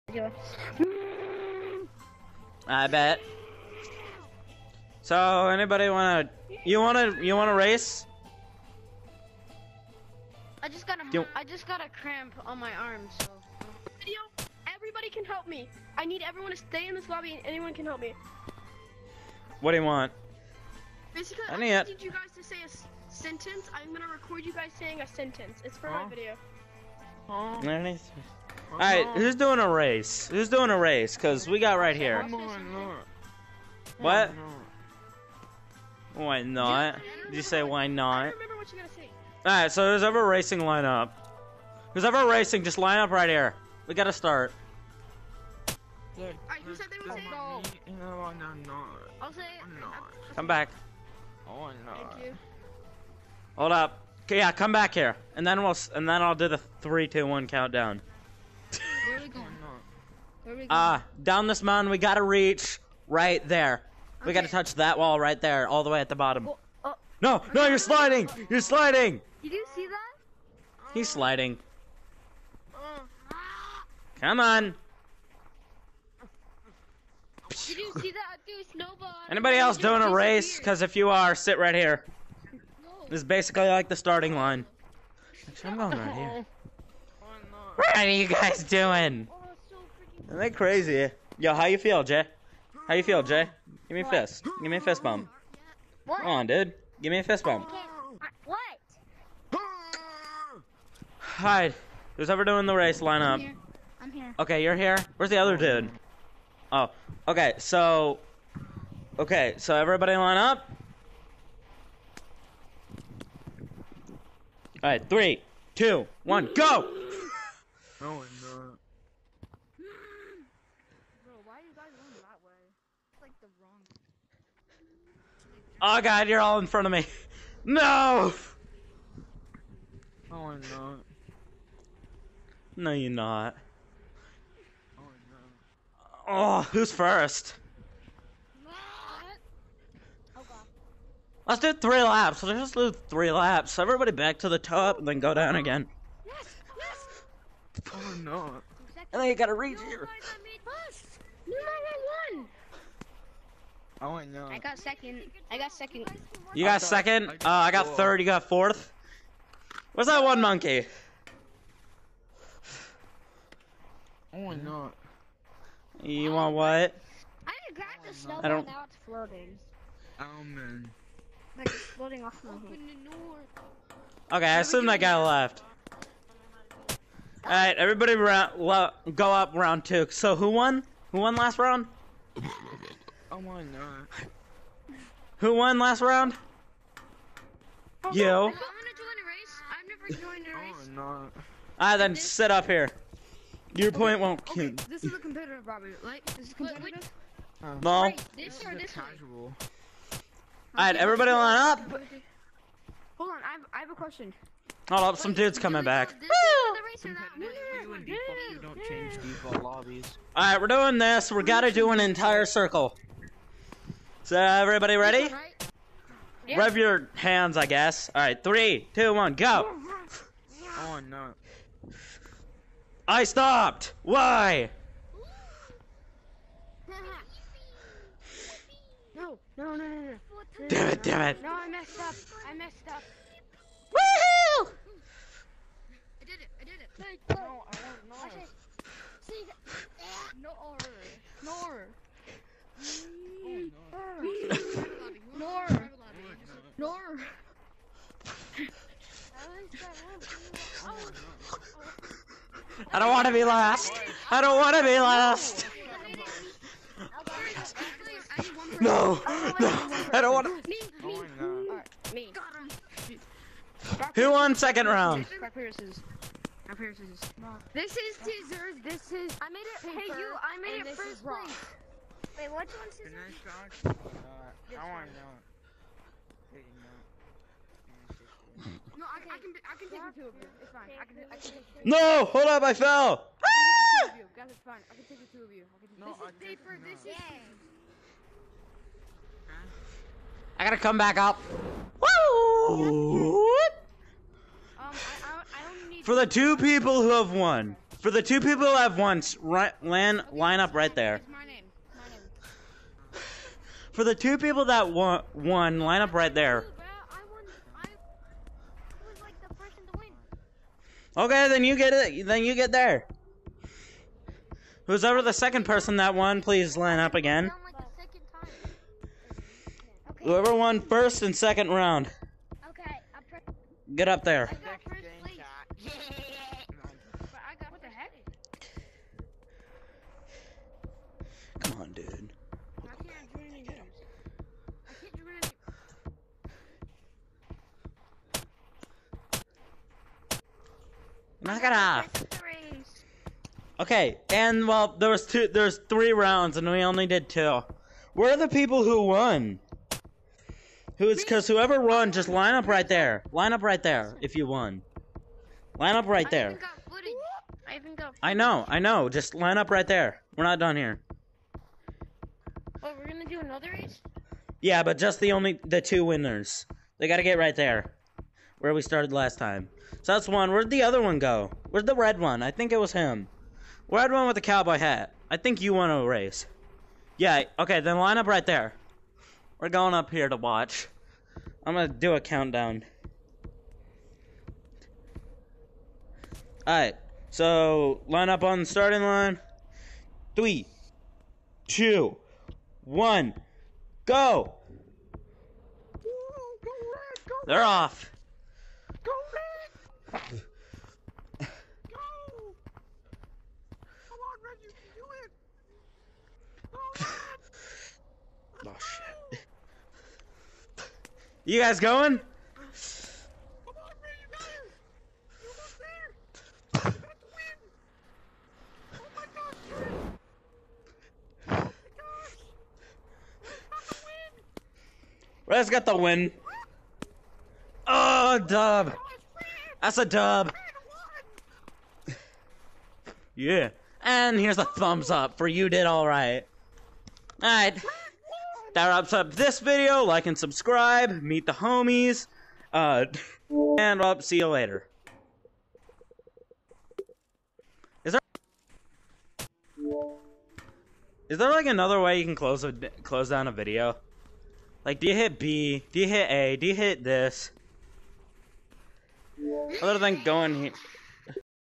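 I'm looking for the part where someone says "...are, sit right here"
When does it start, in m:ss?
1:21.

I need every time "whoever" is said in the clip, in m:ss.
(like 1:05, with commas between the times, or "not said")
5:20, 5:51.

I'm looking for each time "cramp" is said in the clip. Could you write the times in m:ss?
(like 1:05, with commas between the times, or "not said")
0:11.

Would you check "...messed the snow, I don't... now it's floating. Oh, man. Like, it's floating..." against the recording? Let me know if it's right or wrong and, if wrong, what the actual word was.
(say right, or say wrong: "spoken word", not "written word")
wrong: "grabbed", not "messed".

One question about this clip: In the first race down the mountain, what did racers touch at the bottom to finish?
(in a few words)
that wall.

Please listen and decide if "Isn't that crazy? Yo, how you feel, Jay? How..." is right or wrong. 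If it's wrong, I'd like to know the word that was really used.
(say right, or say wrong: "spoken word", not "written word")
right.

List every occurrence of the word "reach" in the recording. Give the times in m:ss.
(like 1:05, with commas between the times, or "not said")
1:02, 2:29.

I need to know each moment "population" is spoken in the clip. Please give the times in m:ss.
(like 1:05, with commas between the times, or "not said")
not said.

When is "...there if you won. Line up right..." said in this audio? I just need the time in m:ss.
5:53.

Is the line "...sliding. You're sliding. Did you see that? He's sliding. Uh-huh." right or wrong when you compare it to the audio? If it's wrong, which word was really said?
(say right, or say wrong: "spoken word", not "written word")
right.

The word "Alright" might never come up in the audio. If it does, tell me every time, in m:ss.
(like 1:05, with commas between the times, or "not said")
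1:54, 2:57, 3:20, 3:26, 6:26.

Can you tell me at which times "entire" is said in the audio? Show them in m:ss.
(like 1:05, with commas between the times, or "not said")
3:32.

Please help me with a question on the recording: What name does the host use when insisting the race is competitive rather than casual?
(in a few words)
Robert.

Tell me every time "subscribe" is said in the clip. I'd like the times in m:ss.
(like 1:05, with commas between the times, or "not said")
7:20.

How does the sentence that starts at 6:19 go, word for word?
We're going up here to watch.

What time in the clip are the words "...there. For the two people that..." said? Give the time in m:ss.
5:00.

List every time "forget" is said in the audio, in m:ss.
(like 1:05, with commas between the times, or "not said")
not said.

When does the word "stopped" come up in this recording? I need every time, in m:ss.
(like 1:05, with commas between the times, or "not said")
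3:43.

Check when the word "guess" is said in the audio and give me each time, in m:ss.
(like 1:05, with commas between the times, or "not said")
3:37.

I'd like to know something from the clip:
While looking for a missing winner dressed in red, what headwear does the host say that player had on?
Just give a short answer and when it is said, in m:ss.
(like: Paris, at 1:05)
cowboy hat, at 6:14.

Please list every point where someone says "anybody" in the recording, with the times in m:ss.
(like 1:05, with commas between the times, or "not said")
0:05, 1:19.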